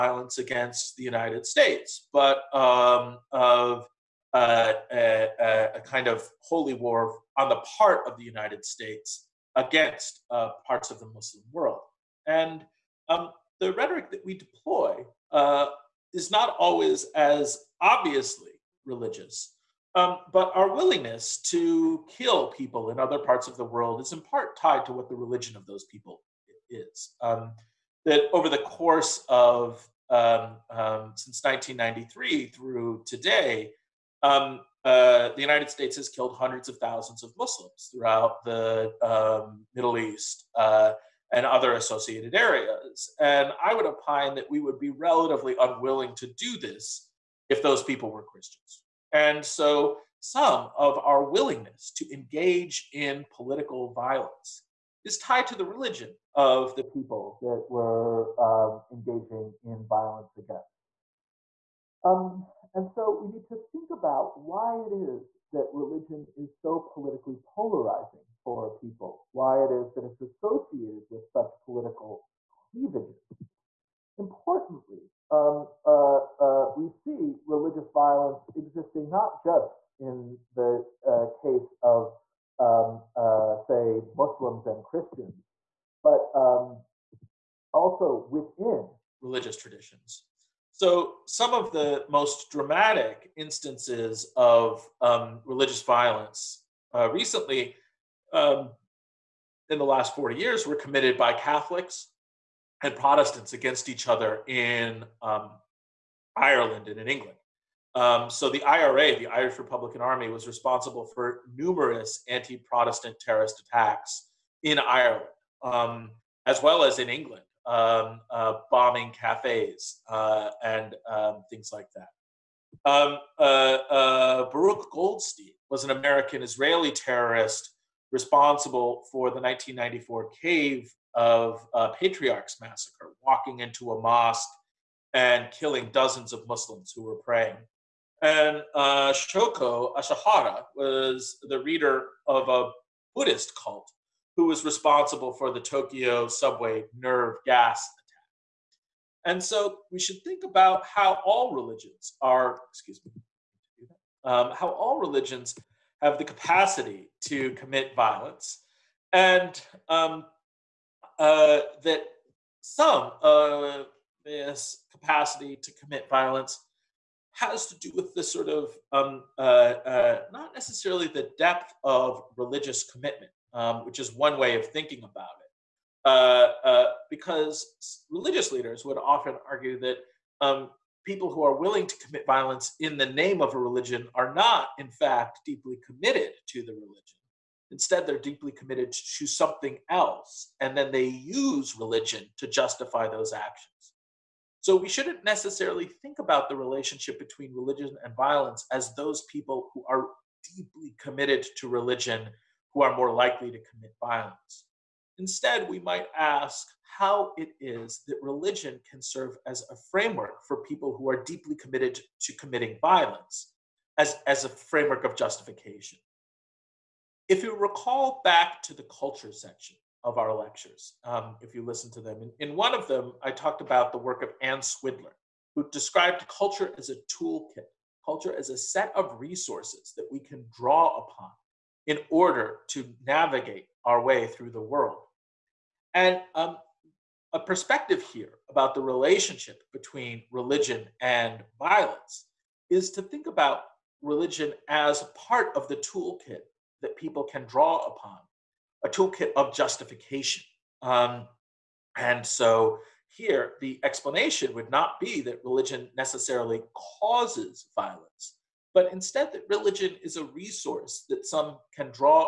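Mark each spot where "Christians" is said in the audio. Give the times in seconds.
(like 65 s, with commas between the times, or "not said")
48 s, 84 s.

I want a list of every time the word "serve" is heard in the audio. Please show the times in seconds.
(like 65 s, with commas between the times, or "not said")
209 s.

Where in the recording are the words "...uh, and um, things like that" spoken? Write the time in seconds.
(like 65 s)
120 s.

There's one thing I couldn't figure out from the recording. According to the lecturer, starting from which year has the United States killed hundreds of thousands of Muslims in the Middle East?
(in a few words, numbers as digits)
1993.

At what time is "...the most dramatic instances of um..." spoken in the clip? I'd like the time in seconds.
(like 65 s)
91 s.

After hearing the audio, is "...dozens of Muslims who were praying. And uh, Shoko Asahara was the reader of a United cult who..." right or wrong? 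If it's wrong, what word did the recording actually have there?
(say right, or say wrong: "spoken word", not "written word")
wrong: "Buddhist", not "United".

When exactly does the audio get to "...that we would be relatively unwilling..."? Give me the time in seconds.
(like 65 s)
44 s.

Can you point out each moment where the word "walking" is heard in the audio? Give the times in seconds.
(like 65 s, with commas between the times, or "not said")
133 s.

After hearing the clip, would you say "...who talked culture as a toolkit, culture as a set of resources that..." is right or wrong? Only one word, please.
wrong.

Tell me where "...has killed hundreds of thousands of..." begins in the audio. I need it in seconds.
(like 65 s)
35 s.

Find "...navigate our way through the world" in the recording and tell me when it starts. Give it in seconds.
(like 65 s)
233 s.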